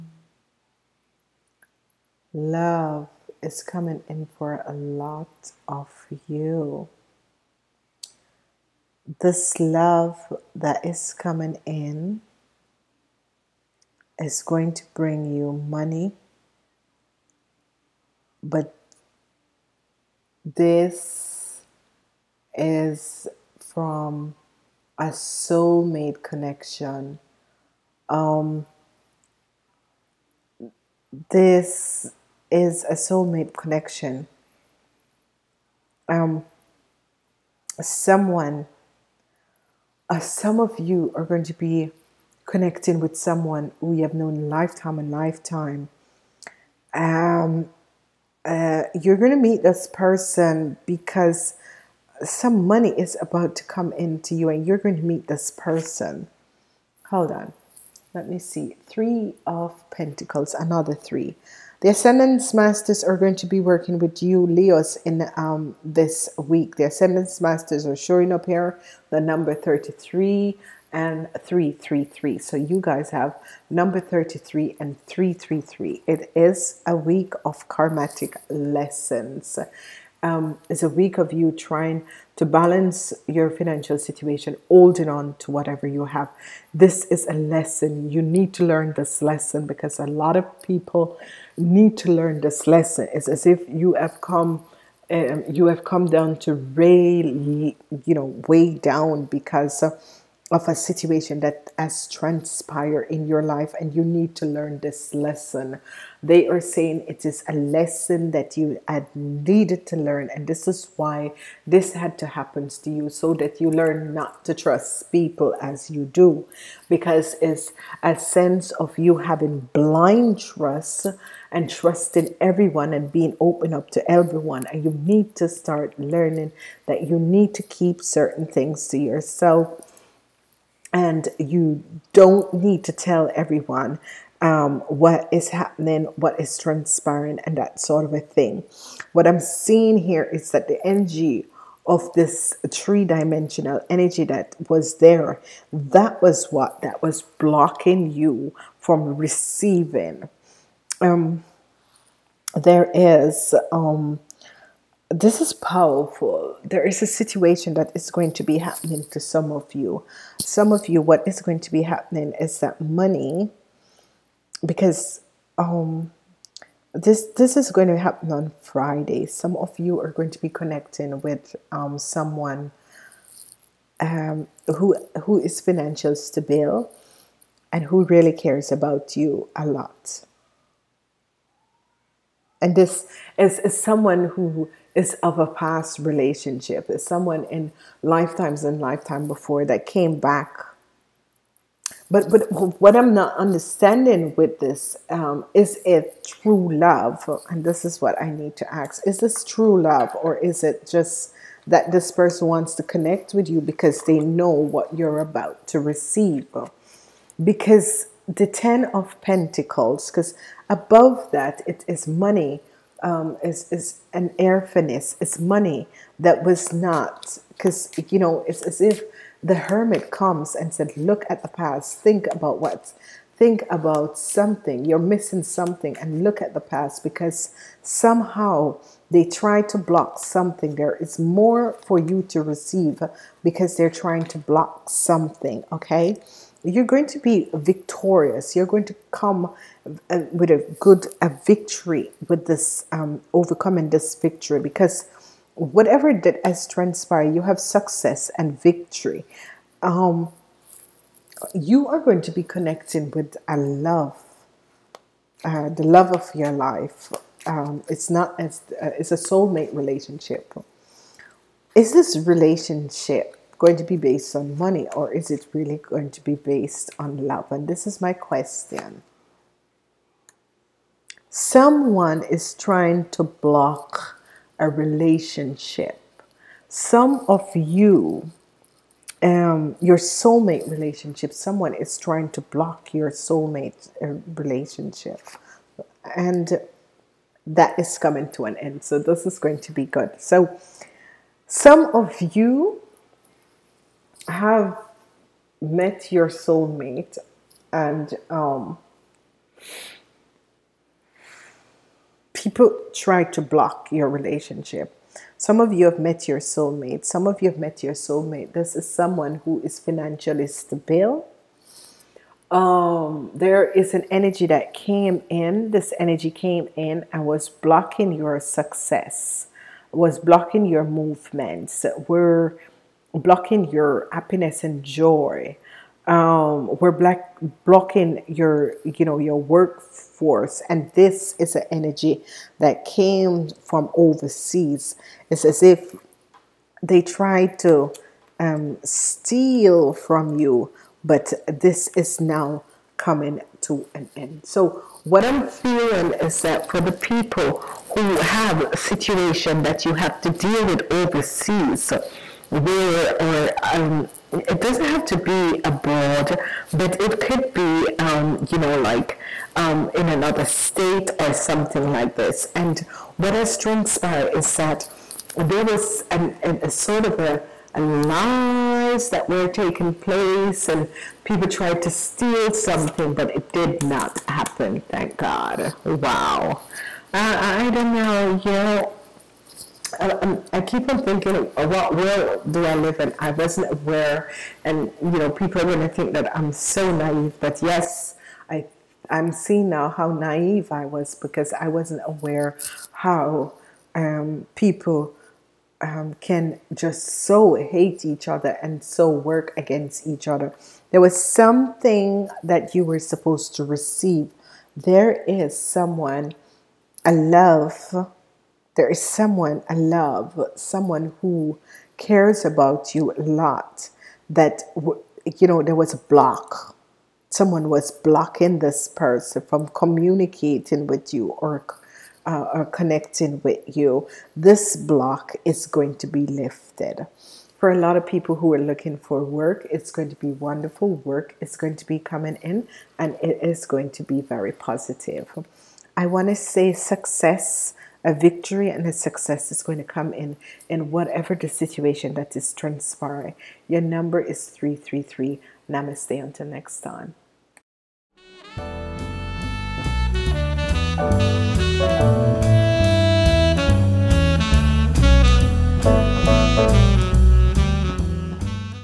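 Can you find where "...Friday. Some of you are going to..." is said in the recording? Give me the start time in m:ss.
2:48.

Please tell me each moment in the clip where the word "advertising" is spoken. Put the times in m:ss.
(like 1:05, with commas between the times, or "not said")
not said.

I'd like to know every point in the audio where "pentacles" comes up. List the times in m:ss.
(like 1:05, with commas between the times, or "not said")
0:59, 3:29.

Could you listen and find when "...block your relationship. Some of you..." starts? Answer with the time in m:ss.
5:03.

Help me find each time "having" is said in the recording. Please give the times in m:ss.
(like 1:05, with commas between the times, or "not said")
1:59.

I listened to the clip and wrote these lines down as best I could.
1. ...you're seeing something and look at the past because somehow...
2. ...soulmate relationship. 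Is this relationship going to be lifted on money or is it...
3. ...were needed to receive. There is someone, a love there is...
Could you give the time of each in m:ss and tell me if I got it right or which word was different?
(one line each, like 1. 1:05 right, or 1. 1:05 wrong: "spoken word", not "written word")
1. 3:44 wrong: "missing", not "seeing"
2. 4:19 wrong: "based", not "lifted"
3. 6:42 wrong: "supposed", not "needed".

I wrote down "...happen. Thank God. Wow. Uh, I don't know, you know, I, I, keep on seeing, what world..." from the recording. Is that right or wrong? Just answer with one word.
wrong.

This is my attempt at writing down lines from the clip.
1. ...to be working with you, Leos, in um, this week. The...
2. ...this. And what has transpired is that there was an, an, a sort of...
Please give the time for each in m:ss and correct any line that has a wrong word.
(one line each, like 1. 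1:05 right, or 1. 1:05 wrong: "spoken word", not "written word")
1. 1:03 right
2. 6:02 right.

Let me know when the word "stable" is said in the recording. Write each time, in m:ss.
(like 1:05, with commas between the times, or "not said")
2:56, 5:10.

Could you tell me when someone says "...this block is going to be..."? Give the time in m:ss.
7:04.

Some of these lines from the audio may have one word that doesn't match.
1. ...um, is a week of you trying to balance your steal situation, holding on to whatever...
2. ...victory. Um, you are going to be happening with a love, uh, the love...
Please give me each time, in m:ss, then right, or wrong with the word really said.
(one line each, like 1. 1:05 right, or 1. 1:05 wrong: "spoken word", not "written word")
1. 1:20 wrong: "financial", not "steal"
2. 4:08 wrong: "connecting", not "happening".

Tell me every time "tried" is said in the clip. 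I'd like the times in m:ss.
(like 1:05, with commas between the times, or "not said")
5:37, 6:11.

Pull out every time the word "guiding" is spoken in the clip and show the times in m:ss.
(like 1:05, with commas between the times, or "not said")
not said.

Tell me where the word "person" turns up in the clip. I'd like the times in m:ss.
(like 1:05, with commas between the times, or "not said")
0:49, 0:55, 3:22, 6:58.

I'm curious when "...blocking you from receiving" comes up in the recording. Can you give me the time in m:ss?
2:27.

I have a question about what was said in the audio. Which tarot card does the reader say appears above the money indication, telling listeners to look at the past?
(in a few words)
The Hermit.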